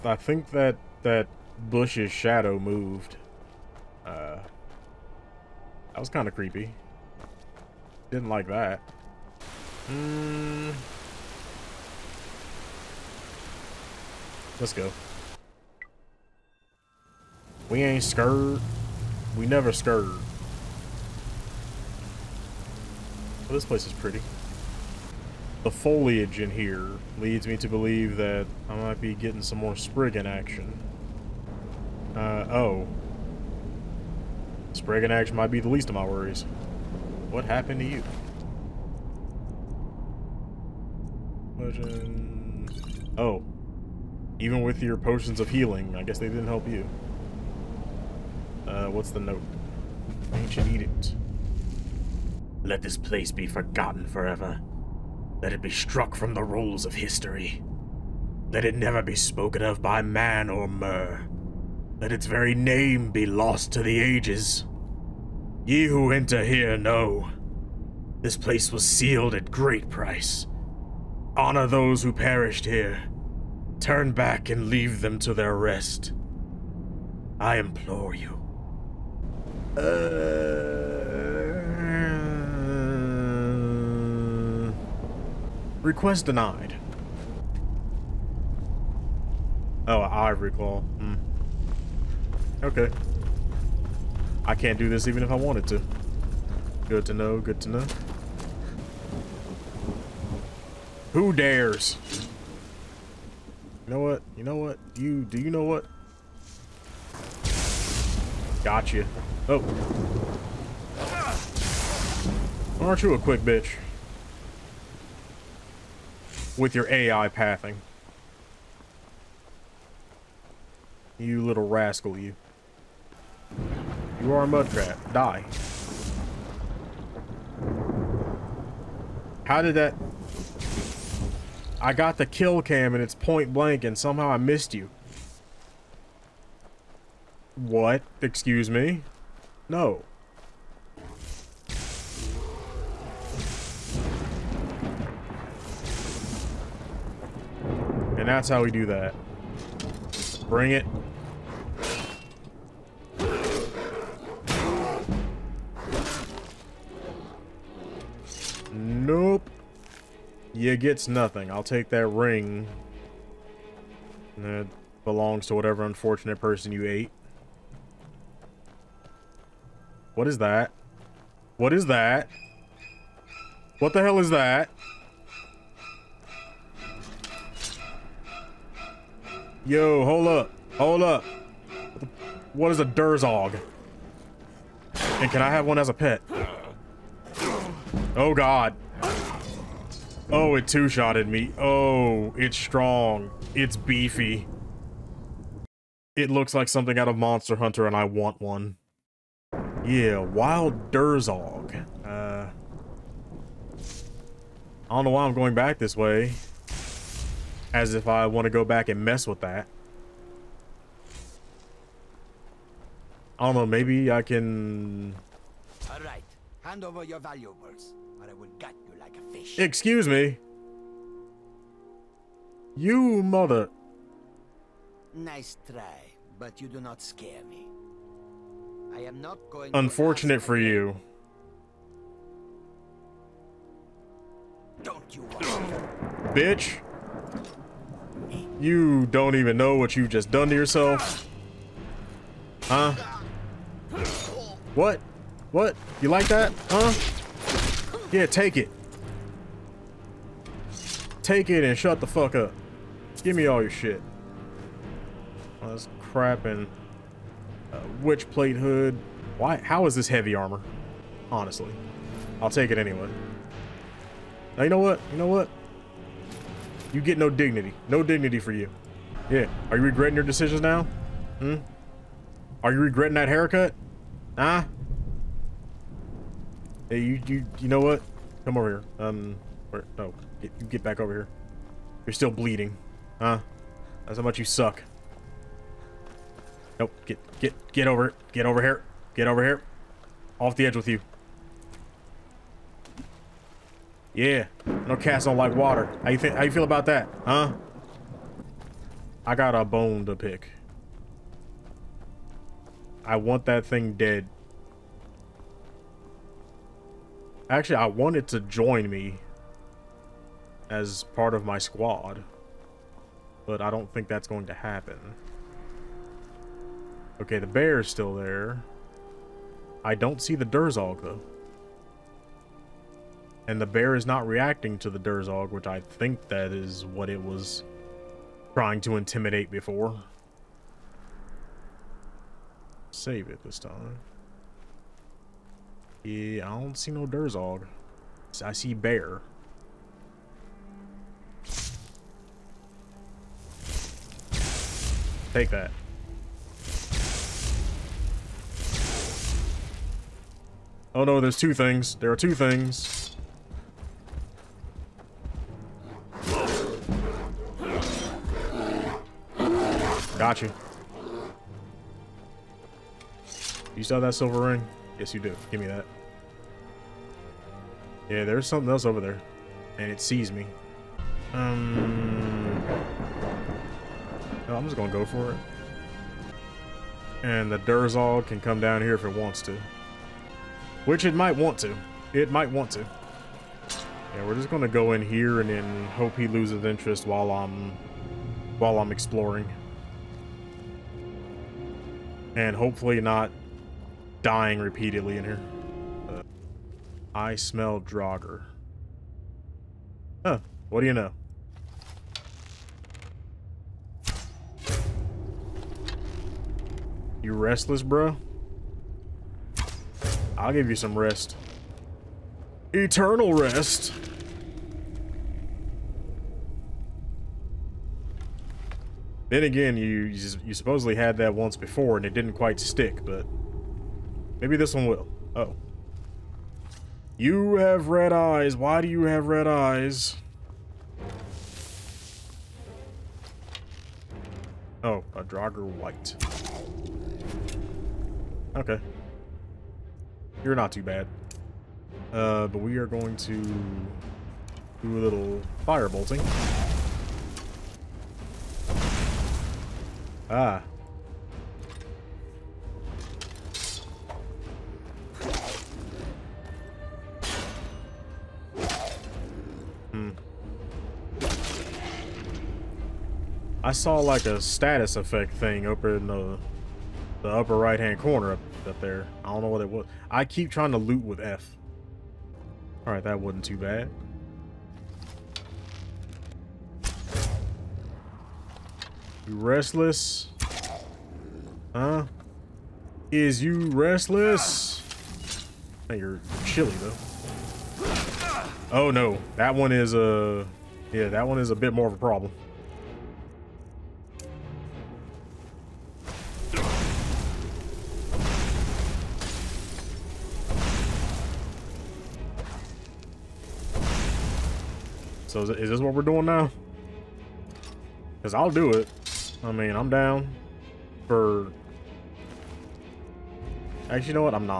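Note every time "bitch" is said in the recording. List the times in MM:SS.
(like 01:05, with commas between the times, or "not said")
01:53, 03:56.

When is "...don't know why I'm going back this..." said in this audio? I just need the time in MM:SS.
03:24.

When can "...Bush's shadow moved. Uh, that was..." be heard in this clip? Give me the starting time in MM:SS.
00:01.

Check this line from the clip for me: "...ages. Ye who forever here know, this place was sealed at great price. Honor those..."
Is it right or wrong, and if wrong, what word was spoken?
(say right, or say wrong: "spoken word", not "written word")
wrong: "enter", not "forever".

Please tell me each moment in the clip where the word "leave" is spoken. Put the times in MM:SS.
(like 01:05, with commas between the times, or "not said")
01:14.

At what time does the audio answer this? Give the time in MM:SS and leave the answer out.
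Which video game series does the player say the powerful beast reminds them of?
03:17.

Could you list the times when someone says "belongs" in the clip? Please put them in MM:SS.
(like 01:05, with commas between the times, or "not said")
02:45.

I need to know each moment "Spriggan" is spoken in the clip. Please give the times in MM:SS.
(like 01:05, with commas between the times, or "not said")
00:29, 00:34.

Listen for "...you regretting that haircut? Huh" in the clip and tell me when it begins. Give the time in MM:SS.
04:32.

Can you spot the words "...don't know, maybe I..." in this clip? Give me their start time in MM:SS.
03:33.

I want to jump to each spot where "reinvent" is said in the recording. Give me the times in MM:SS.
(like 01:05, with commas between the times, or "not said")
not said.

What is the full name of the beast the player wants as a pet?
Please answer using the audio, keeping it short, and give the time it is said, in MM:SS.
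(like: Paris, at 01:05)
Wild Durzog, at 03:20.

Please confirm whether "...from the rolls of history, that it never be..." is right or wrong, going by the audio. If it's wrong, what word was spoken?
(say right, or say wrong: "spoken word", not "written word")
right.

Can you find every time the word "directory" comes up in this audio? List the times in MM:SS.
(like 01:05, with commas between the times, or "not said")
not said.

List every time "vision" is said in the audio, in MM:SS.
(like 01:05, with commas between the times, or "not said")
not said.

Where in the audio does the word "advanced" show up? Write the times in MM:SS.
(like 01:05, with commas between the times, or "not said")
not said.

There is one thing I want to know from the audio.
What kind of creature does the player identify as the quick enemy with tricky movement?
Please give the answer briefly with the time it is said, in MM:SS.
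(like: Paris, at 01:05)
Mudcrab, at 02:04.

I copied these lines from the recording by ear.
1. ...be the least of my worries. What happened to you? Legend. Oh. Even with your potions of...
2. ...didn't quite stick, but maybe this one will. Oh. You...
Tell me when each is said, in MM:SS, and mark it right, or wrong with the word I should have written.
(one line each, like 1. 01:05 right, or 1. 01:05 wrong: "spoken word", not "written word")
1. 00:35 right
2. 07:02 right.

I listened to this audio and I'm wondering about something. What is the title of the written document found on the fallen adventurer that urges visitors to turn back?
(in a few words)
Ancient edict.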